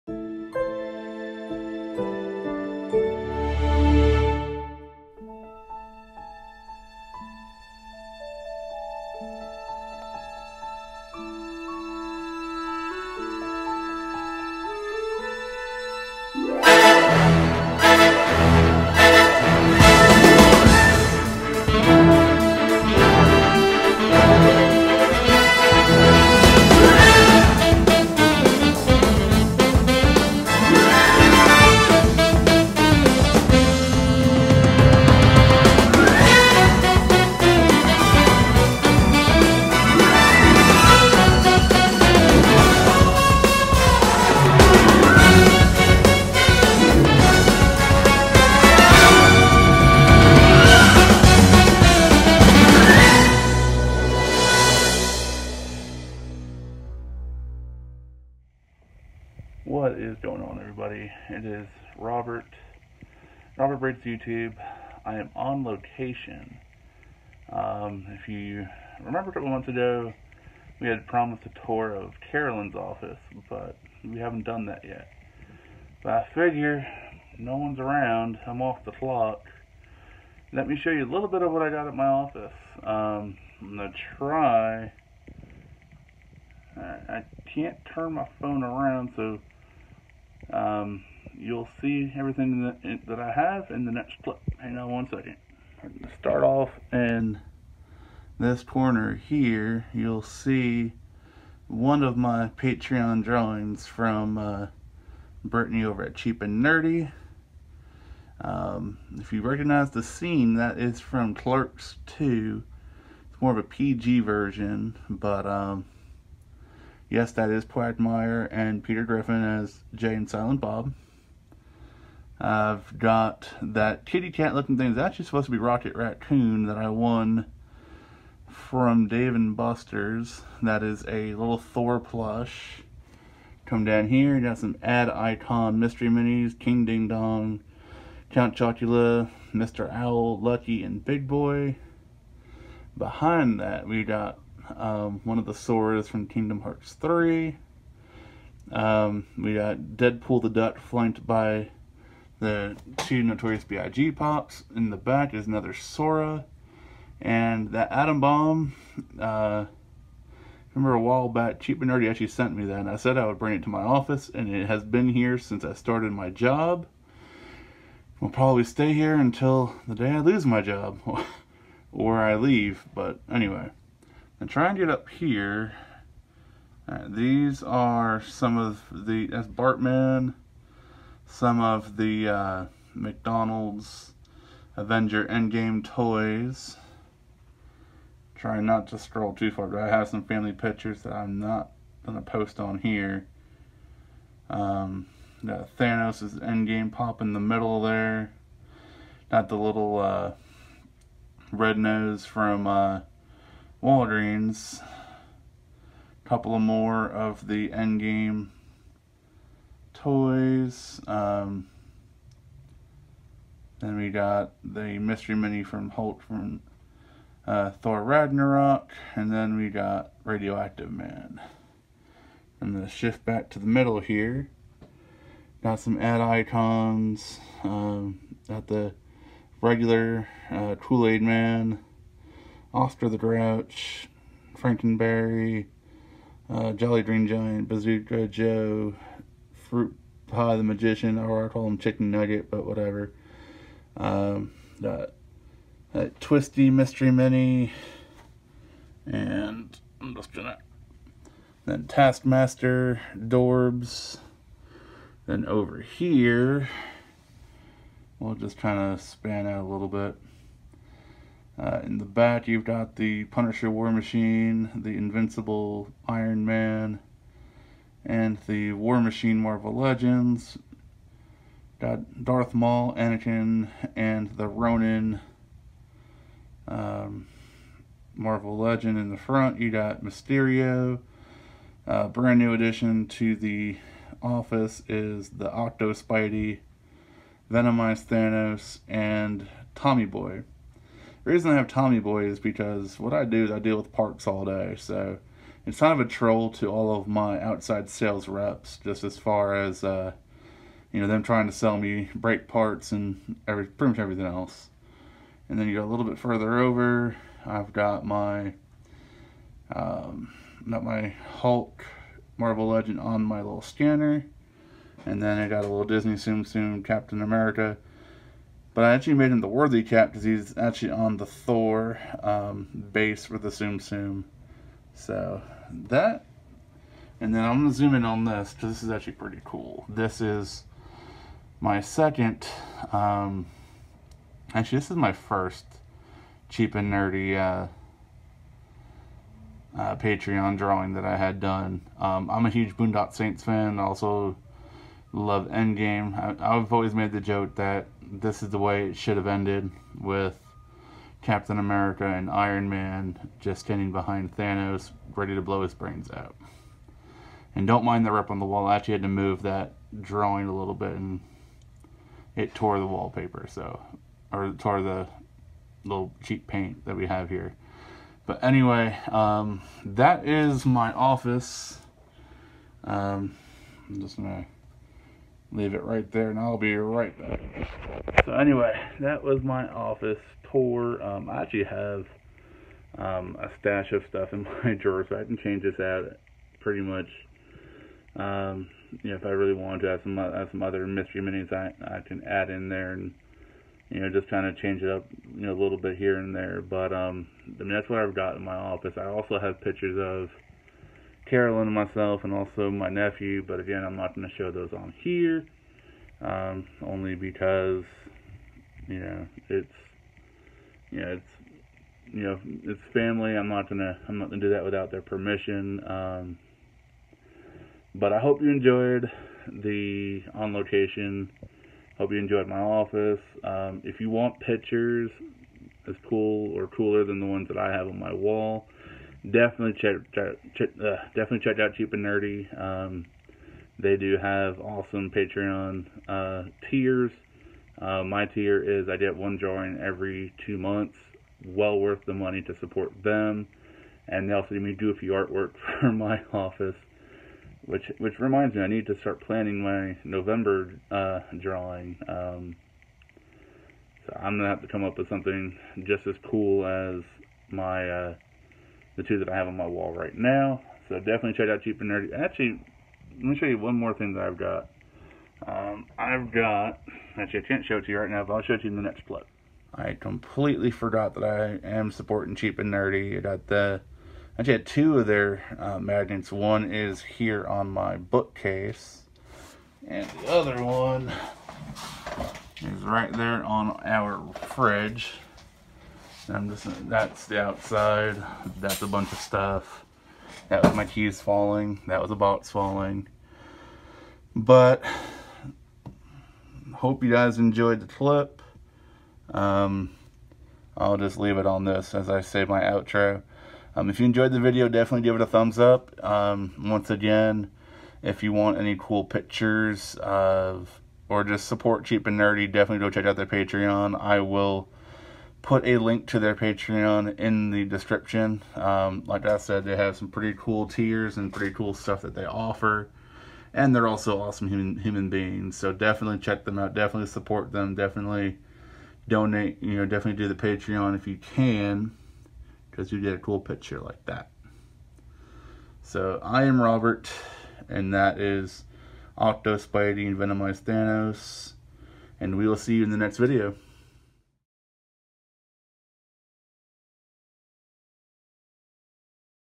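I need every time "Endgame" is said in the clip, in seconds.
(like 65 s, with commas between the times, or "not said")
185 s, 196 s, 207 s, 345 s.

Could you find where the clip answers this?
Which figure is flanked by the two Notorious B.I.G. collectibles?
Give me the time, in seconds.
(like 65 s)
149 s.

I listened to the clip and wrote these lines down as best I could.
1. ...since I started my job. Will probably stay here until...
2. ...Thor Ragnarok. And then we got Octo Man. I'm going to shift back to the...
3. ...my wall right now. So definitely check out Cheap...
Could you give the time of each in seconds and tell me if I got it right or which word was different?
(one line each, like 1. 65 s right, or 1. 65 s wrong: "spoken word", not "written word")
1. 165 s right
2. 217 s wrong: "Radioactive", not "Octo"
3. 459 s right.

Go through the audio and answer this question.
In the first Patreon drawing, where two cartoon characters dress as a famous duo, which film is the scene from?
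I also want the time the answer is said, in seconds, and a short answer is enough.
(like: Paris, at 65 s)
Clerks 2, at 111 s.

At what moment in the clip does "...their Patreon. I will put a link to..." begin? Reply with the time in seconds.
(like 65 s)
513 s.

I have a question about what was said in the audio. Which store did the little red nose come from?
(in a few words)
Walgreens.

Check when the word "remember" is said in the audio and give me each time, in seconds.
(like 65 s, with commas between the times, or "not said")
69 s, 160 s.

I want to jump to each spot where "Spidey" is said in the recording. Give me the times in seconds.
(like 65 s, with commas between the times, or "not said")
285 s, 539 s.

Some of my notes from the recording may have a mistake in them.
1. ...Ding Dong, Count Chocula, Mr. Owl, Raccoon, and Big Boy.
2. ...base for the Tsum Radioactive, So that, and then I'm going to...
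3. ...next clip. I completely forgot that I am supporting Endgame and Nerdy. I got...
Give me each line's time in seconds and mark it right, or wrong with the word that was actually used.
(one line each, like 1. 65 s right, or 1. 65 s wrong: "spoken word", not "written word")
1. 136 s wrong: "Lucky", not "Raccoon"
2. 322 s wrong: "Tsum", not "Radioactive"
3. 468 s wrong: "Cheap", not "Endgame".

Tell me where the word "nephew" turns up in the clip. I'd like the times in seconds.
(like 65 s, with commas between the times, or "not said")
402 s.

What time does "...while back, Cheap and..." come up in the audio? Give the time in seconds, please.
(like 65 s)
161 s.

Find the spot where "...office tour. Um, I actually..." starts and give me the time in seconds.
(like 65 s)
379 s.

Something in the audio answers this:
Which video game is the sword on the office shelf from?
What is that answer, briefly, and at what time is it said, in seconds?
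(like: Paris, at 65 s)
Kingdom Hearts 3, at 146 s.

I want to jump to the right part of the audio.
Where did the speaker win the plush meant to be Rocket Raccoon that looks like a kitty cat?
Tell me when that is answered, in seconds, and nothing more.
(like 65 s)
129 s.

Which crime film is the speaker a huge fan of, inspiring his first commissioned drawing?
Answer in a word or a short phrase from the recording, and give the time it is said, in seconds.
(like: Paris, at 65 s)
Boondock Saints, at 342 s.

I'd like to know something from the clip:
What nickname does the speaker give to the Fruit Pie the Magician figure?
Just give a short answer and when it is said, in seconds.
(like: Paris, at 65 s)
Chicken Nugget, at 241 s.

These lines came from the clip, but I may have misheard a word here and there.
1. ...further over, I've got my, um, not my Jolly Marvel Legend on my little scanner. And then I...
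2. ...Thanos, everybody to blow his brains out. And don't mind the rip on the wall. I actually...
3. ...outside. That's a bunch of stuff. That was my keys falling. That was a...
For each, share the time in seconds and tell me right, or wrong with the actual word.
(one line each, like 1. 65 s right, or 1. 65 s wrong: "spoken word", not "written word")
1. 306 s wrong: "Hulk", not "Jolly"
2. 354 s wrong: "ready", not "everybody"
3. 487 s right.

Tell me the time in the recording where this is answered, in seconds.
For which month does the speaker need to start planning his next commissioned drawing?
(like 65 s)
450 s.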